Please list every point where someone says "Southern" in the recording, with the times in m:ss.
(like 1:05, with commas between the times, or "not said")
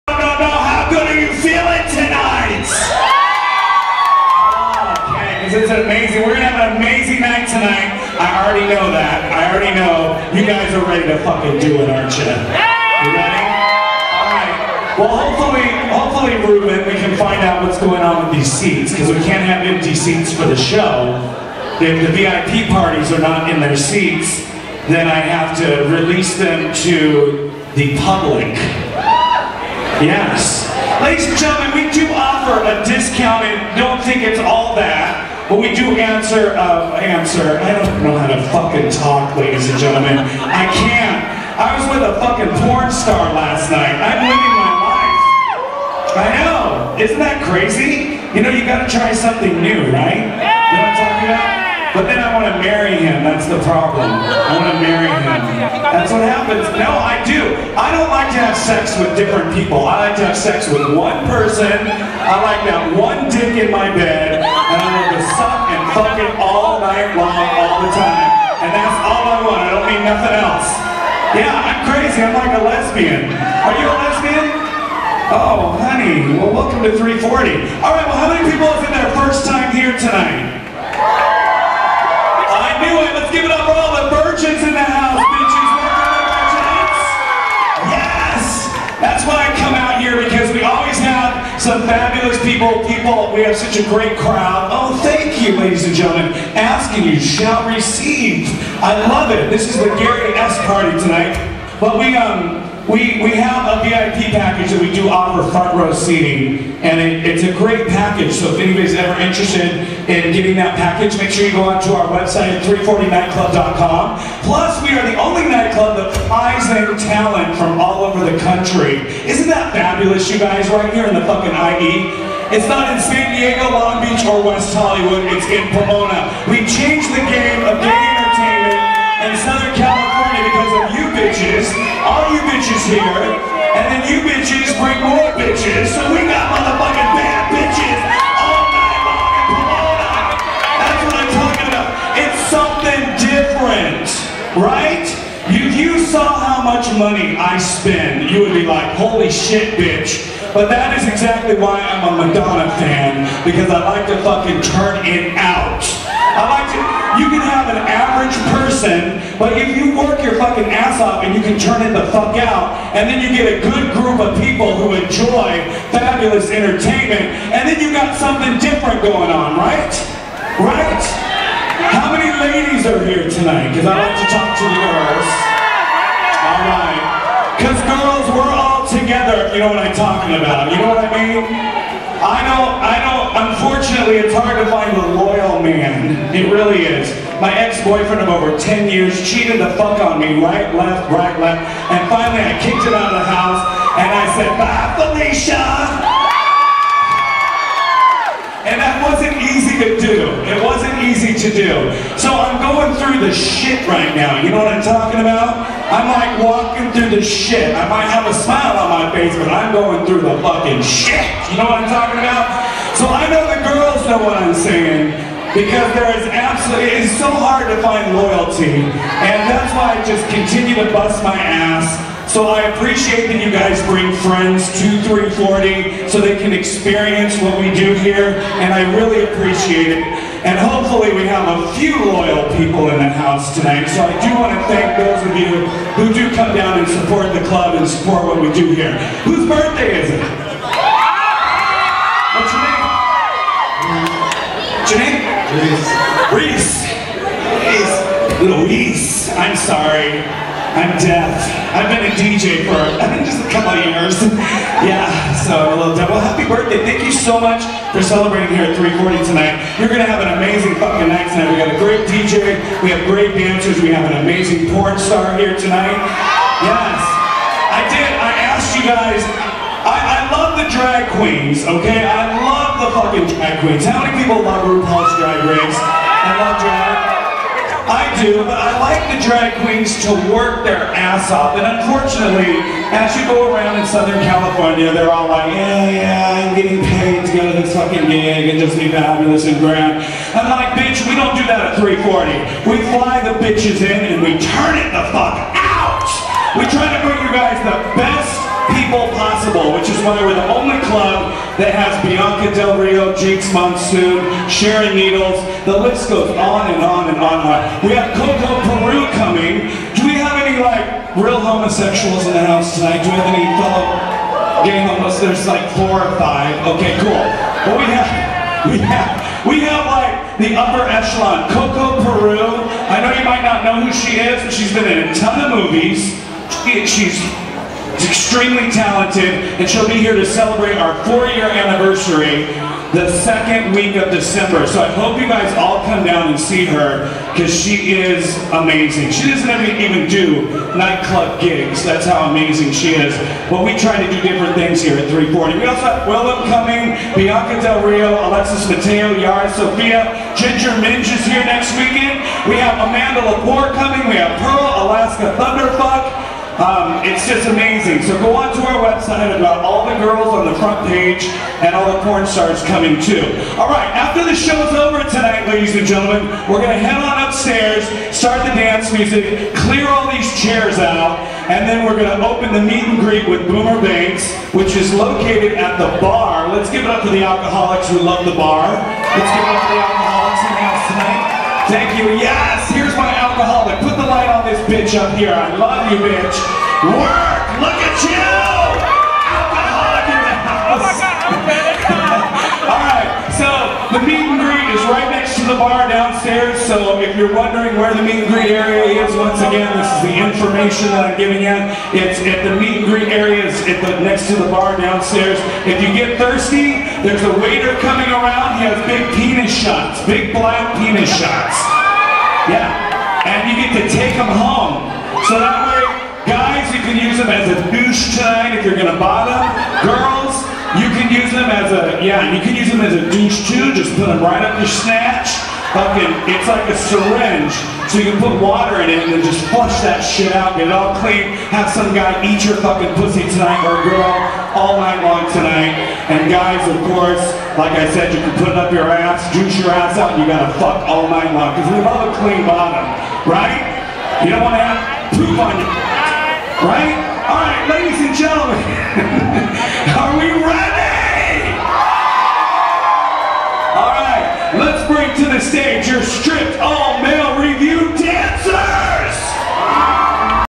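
2:09, 4:43.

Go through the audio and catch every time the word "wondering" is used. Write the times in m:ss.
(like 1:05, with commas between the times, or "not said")
6:37.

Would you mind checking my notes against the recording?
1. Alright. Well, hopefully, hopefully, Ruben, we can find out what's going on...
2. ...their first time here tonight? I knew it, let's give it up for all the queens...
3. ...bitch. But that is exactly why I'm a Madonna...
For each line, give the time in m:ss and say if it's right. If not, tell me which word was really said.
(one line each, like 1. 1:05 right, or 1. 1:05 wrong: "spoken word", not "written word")
1. 0:13 right
2. 1:18 wrong: "virgins", not "queens"
3. 2:29 right.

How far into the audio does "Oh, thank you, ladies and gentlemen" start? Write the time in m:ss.
1:34.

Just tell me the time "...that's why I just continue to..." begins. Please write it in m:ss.
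3:39.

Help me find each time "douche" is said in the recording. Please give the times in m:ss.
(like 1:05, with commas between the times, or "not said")
6:57, 7:03.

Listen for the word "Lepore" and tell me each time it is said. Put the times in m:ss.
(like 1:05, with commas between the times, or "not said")
5:53.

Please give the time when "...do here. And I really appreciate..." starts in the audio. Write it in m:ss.
3:47.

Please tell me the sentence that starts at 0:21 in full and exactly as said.
If the VIP parties are not in their seats, then I have to release them to the public.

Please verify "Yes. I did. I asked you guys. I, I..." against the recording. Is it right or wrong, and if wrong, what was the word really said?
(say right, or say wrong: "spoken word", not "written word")
right.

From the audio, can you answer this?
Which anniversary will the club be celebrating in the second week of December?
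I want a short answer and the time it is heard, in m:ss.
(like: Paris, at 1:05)
Four-year, at 5:31.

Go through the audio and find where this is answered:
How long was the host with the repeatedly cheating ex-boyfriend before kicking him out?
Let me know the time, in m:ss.
3:08.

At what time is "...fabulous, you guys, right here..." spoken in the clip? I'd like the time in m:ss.
1:59.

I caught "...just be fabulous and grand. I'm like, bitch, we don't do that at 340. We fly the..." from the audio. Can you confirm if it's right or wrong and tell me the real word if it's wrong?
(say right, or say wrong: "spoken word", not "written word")
right.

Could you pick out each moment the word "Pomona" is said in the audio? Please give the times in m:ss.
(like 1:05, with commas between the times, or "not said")
2:05, 2:19.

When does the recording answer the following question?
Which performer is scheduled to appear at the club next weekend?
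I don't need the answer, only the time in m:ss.
5:50.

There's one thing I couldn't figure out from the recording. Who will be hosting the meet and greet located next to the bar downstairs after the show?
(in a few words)
Boomer Banks.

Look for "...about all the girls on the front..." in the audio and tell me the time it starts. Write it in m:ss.
5:59.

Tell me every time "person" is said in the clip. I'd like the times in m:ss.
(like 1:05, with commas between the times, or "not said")
1:01, 2:38.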